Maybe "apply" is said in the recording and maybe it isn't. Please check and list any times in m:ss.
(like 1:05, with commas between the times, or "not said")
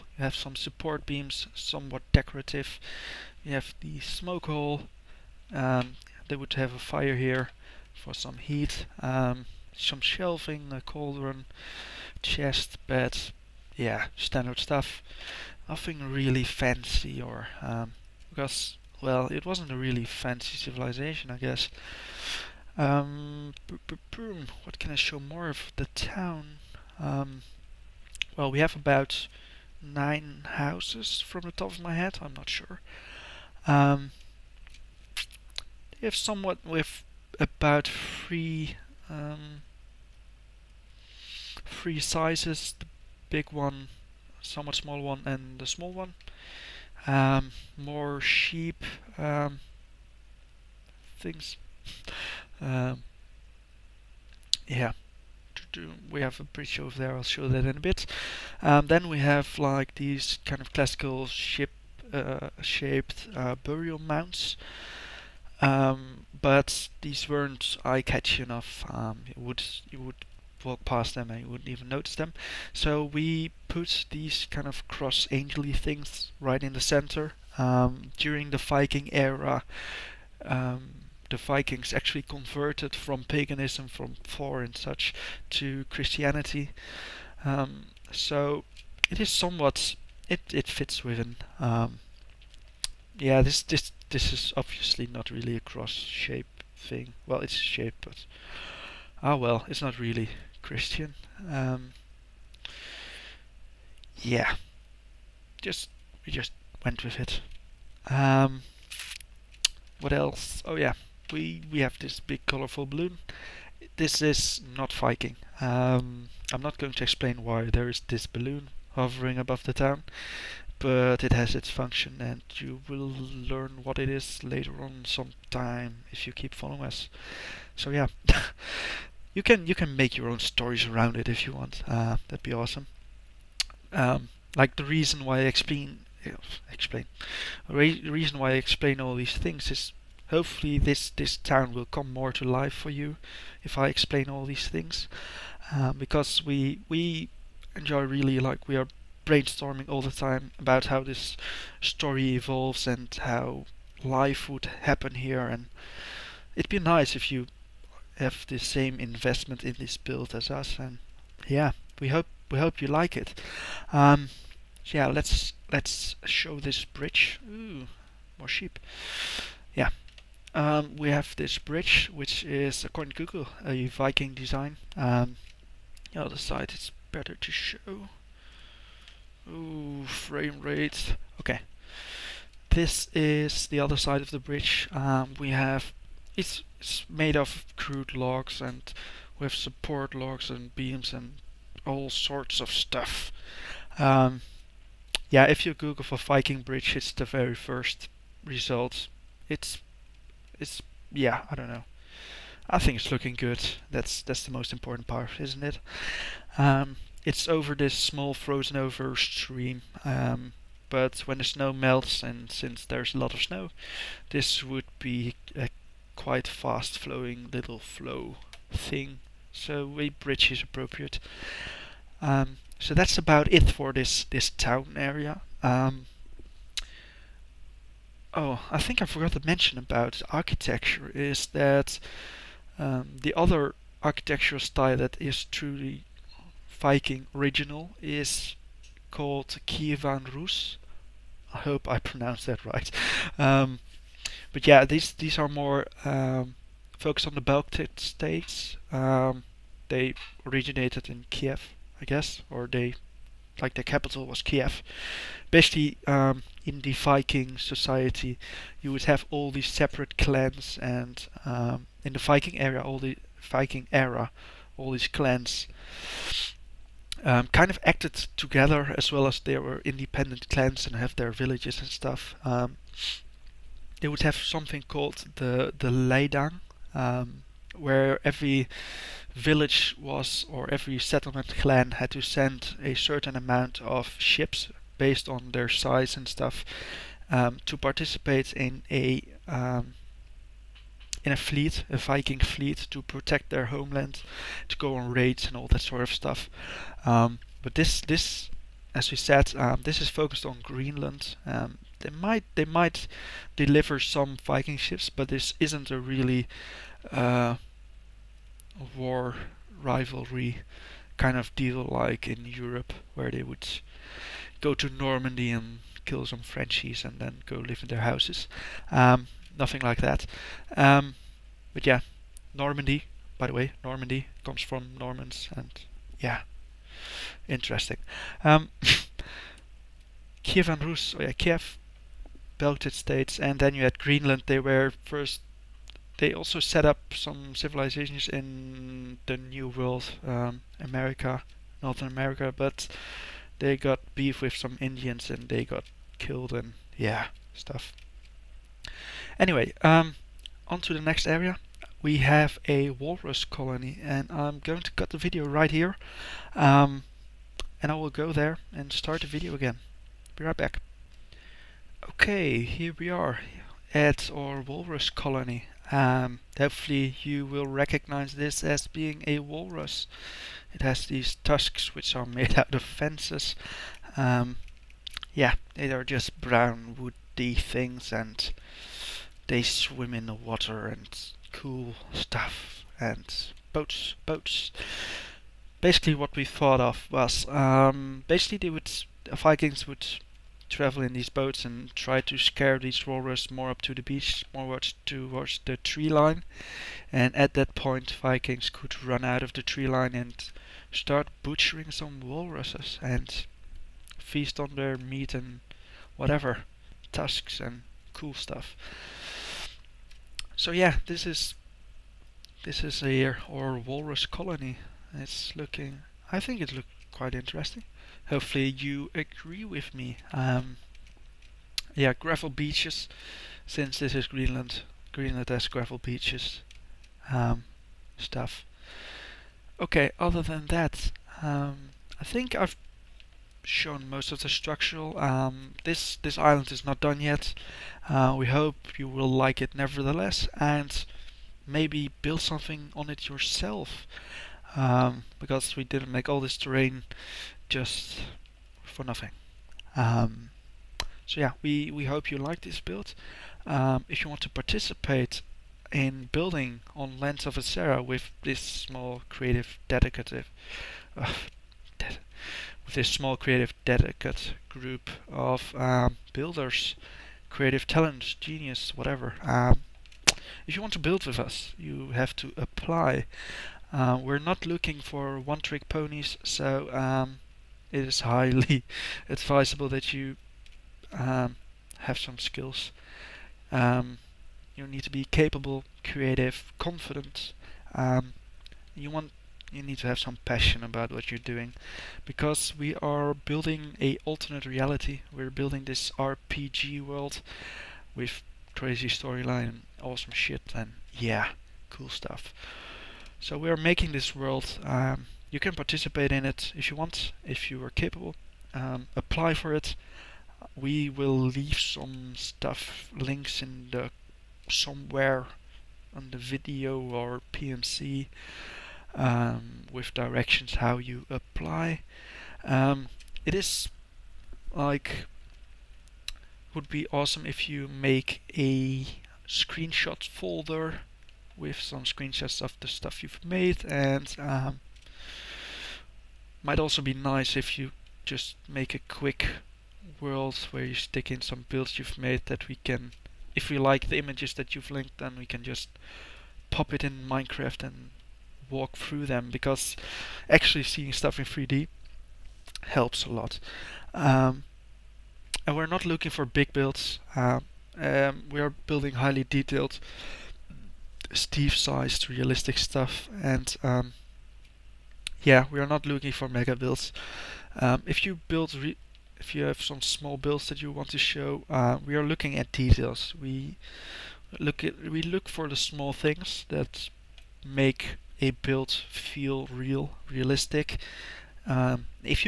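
7:52, 8:29, 8:41.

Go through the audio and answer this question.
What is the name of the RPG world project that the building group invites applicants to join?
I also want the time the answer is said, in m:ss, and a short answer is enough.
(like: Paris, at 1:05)
Lands of Asera, at 7:37.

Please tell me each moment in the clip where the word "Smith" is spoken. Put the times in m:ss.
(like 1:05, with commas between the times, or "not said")
not said.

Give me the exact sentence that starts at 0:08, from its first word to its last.
Um, some shelving, a cauldron, chest, bed, yeah, standard stuff.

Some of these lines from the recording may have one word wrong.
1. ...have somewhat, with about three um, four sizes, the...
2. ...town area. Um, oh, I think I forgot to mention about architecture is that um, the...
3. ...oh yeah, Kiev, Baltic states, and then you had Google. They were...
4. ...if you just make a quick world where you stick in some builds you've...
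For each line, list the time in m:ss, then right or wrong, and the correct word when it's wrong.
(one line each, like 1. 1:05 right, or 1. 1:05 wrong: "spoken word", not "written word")
1. 0:36 wrong: "three", not "four"
2. 3:44 right
3. 5:31 wrong: "Greenland", not "Google"
4. 8:57 right.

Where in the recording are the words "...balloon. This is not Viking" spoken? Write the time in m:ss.
1:52.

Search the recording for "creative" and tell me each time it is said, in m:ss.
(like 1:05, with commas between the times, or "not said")
7:39, 7:43, 7:47, 8:06.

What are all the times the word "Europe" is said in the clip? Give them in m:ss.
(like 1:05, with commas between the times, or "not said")
5:12.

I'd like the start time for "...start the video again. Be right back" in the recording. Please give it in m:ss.
5:58.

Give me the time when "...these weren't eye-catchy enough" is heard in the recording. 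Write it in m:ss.
1:07.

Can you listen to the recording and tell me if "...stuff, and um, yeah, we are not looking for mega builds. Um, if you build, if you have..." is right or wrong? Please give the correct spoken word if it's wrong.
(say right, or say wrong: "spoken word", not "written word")
right.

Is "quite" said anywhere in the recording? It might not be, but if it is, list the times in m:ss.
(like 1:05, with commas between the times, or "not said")
3:36, 6:57.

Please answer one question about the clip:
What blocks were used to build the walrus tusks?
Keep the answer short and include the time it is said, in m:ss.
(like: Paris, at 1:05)
Fences, at 6:12.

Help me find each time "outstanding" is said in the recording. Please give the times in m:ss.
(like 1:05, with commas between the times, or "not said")
not said.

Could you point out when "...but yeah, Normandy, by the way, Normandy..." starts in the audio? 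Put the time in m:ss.
5:21.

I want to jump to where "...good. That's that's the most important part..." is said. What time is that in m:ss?
3:23.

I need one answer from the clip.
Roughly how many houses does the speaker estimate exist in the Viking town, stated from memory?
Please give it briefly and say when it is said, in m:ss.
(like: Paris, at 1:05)
9, at 0:29.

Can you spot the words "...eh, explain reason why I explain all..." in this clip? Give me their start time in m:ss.
2:16.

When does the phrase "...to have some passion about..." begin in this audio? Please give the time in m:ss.
8:09.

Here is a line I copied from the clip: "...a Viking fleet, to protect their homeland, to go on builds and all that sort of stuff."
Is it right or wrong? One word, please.
wrong.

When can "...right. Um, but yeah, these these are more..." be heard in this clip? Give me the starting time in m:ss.
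4:02.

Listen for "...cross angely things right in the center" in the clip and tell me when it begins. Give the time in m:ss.
1:14.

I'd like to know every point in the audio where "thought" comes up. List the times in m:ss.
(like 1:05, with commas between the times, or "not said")
6:26.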